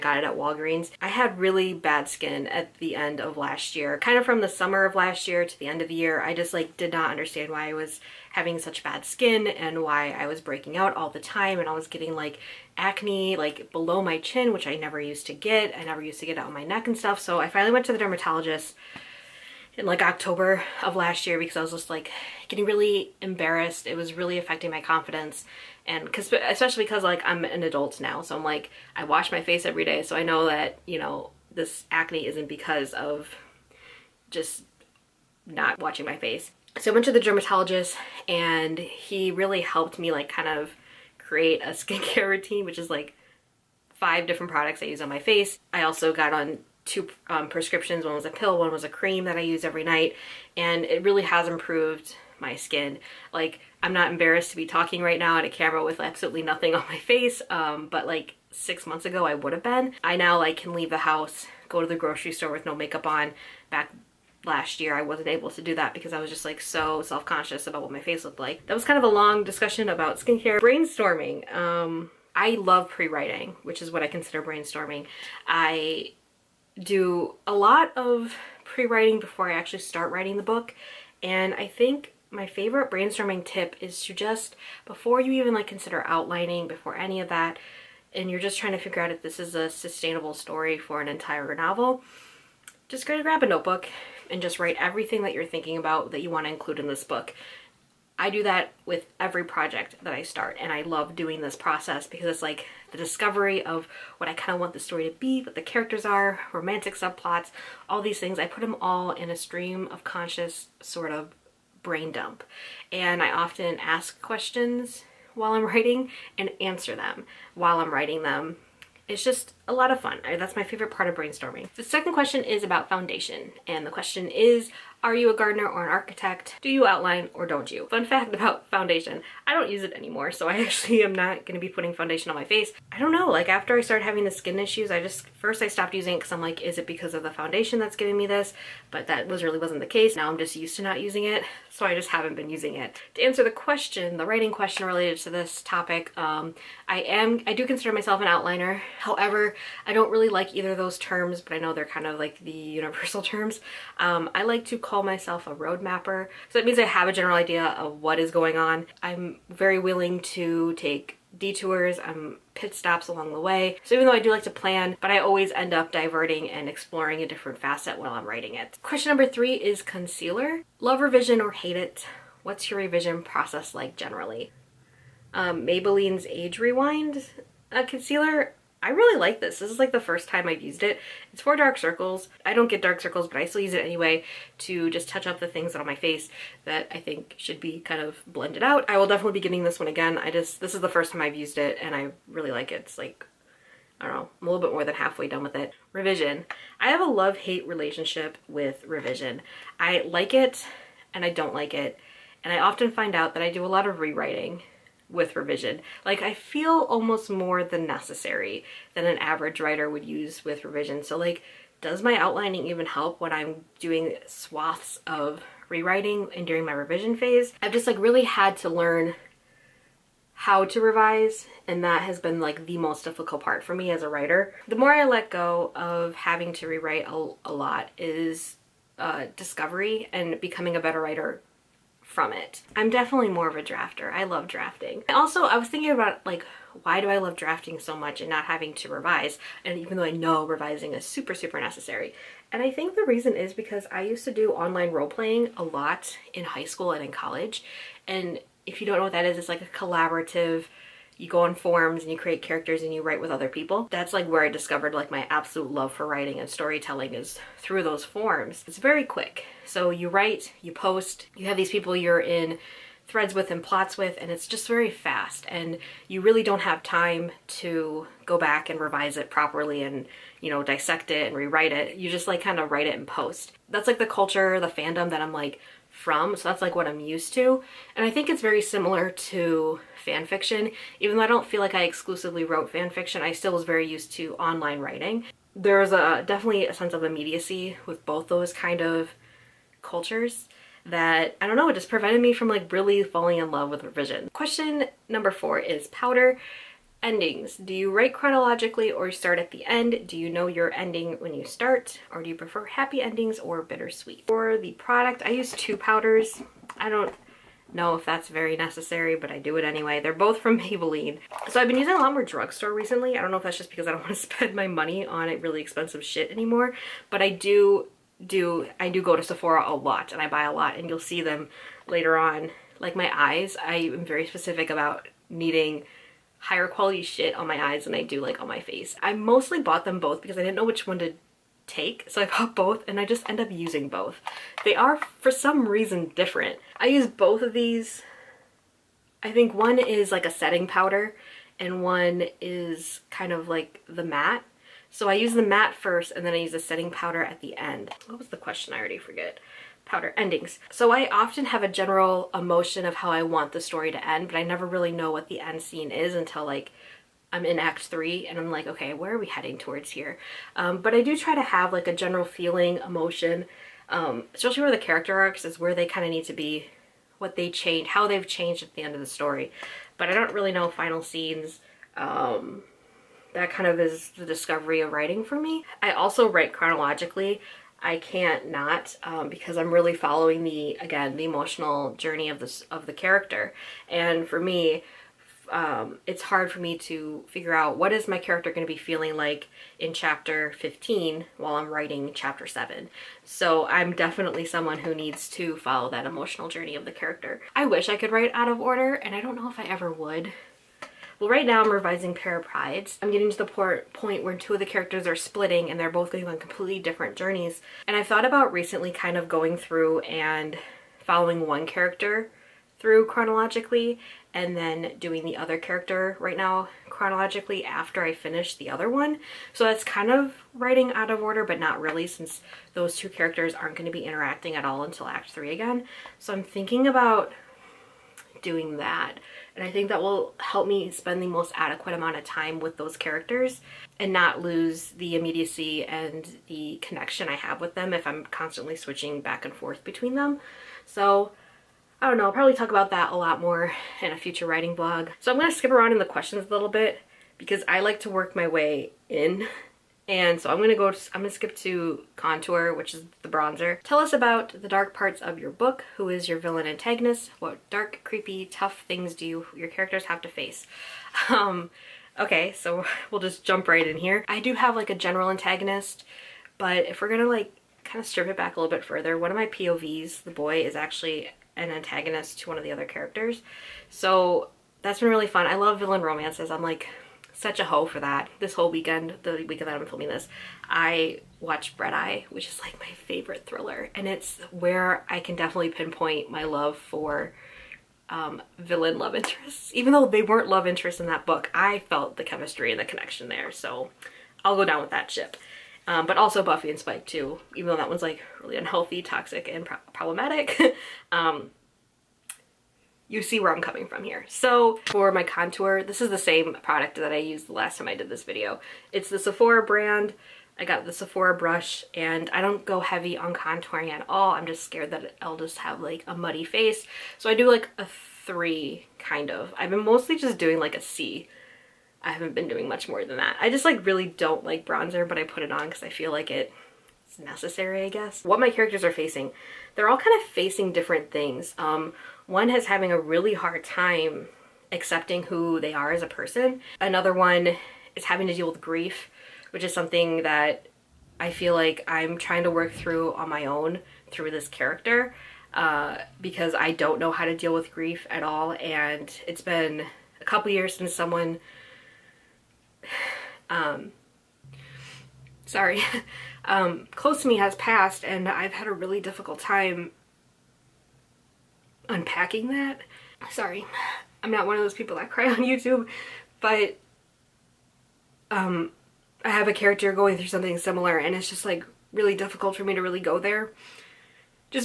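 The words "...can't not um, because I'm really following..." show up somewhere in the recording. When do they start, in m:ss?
6:17.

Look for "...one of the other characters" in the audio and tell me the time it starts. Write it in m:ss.
7:52.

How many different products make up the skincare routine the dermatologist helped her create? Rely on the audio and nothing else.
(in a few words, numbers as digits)
5.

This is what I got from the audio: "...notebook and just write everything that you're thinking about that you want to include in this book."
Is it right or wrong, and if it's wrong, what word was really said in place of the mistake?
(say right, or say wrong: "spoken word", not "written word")
right.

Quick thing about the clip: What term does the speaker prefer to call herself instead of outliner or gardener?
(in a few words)
Road mapper.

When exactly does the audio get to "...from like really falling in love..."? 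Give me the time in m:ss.
4:52.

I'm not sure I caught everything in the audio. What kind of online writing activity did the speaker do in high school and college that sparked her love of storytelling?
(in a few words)
Online role playing.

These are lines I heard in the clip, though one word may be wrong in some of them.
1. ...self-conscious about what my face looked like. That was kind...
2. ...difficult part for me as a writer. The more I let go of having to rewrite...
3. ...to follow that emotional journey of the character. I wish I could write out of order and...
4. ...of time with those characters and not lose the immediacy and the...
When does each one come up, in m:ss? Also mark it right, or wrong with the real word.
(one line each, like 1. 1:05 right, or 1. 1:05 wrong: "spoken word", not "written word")
1. 1:07 right
2. 3:43 right
3. 6:35 right
4. 7:12 right.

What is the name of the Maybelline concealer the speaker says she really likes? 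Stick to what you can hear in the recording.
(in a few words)
Age Rewind.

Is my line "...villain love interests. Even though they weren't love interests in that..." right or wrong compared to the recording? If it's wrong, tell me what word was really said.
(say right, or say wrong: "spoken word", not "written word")
right.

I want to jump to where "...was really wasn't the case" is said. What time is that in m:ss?
2:19.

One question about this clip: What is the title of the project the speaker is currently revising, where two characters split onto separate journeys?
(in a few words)
Pair of Prides.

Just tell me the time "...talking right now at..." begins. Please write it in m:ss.
0:54.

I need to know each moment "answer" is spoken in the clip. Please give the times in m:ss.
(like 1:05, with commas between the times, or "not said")
1:56, 2:23.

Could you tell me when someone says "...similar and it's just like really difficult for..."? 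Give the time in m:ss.
9:30.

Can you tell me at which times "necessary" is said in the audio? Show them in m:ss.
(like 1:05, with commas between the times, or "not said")
3:27, 4:01, 5:08, 8:47.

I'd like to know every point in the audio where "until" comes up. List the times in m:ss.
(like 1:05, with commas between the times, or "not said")
5:56, 7:04.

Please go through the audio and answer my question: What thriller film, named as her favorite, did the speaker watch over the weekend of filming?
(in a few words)
Red Eye.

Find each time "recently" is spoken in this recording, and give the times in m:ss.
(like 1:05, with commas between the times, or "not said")
5:12, 6:48.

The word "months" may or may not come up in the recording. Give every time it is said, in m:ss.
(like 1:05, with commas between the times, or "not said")
0:58.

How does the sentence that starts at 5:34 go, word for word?
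They are for some reason different.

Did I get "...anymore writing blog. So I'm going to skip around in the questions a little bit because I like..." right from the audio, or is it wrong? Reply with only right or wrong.
wrong.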